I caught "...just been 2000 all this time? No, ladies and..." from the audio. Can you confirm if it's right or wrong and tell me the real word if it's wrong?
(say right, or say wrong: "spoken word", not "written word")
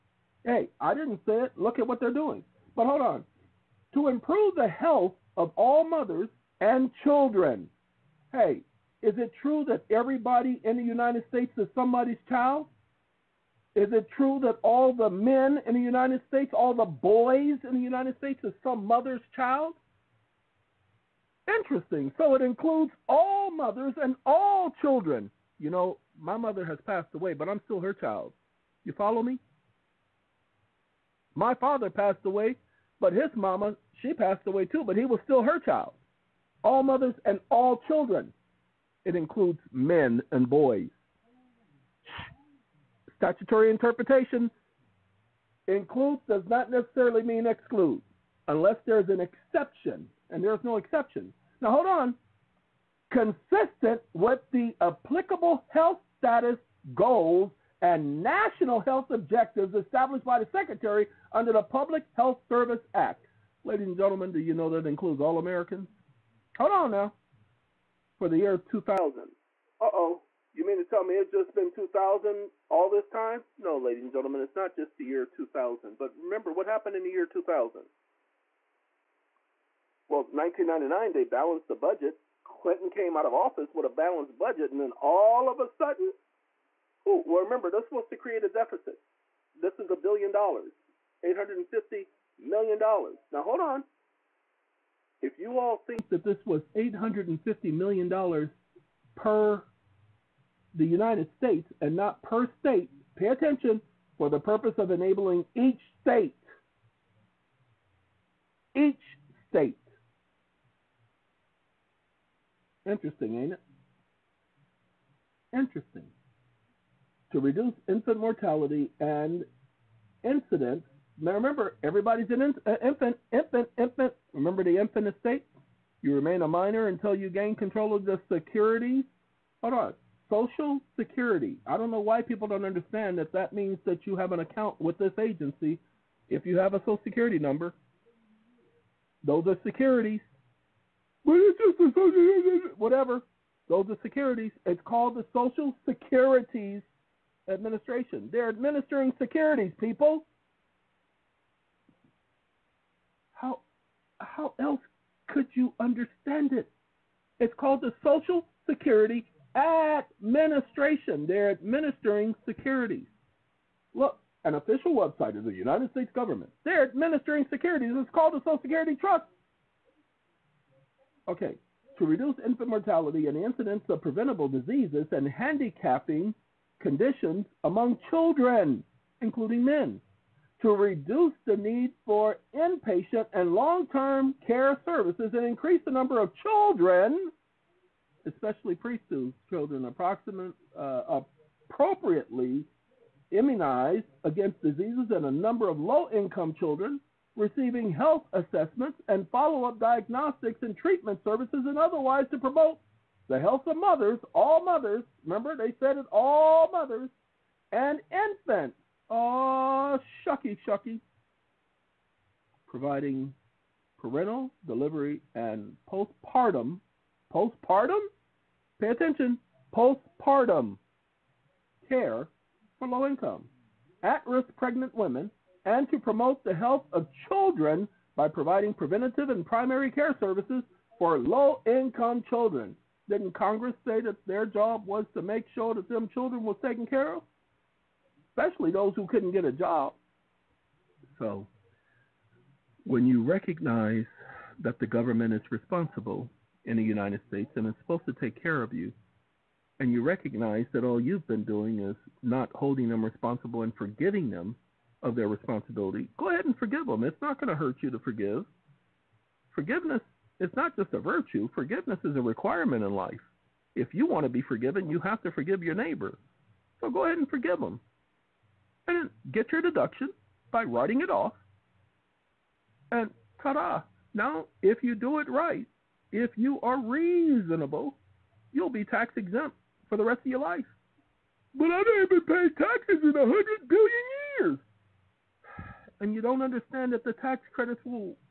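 right.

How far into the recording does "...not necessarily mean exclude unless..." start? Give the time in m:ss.
0:46.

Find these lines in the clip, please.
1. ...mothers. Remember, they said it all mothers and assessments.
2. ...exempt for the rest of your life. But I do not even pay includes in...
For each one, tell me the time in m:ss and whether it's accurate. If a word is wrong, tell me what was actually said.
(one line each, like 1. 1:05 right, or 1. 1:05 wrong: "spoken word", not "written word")
1. 3:24 wrong: "infants", not "assessments"
2. 4:39 wrong: "taxes", not "includes".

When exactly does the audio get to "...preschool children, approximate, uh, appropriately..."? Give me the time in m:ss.
3:08.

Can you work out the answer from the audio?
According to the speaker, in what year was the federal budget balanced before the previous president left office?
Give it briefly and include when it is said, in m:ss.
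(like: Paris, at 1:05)
1999, at 1:20.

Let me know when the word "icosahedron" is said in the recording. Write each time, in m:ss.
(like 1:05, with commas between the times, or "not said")
not said.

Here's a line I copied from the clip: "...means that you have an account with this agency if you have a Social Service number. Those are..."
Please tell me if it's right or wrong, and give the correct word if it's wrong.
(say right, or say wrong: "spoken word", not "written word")
wrong: "Security", not "Service".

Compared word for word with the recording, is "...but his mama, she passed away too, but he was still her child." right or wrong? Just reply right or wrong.
right.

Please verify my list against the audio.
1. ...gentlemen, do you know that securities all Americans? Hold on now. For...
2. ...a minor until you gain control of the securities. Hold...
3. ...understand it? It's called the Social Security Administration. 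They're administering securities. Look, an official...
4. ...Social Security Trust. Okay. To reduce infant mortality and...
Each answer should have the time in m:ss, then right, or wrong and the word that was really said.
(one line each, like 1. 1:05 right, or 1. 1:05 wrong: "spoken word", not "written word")
1. 1:03 wrong: "includes", not "securities"
2. 2:06 right
3. 2:35 right
4. 2:48 right.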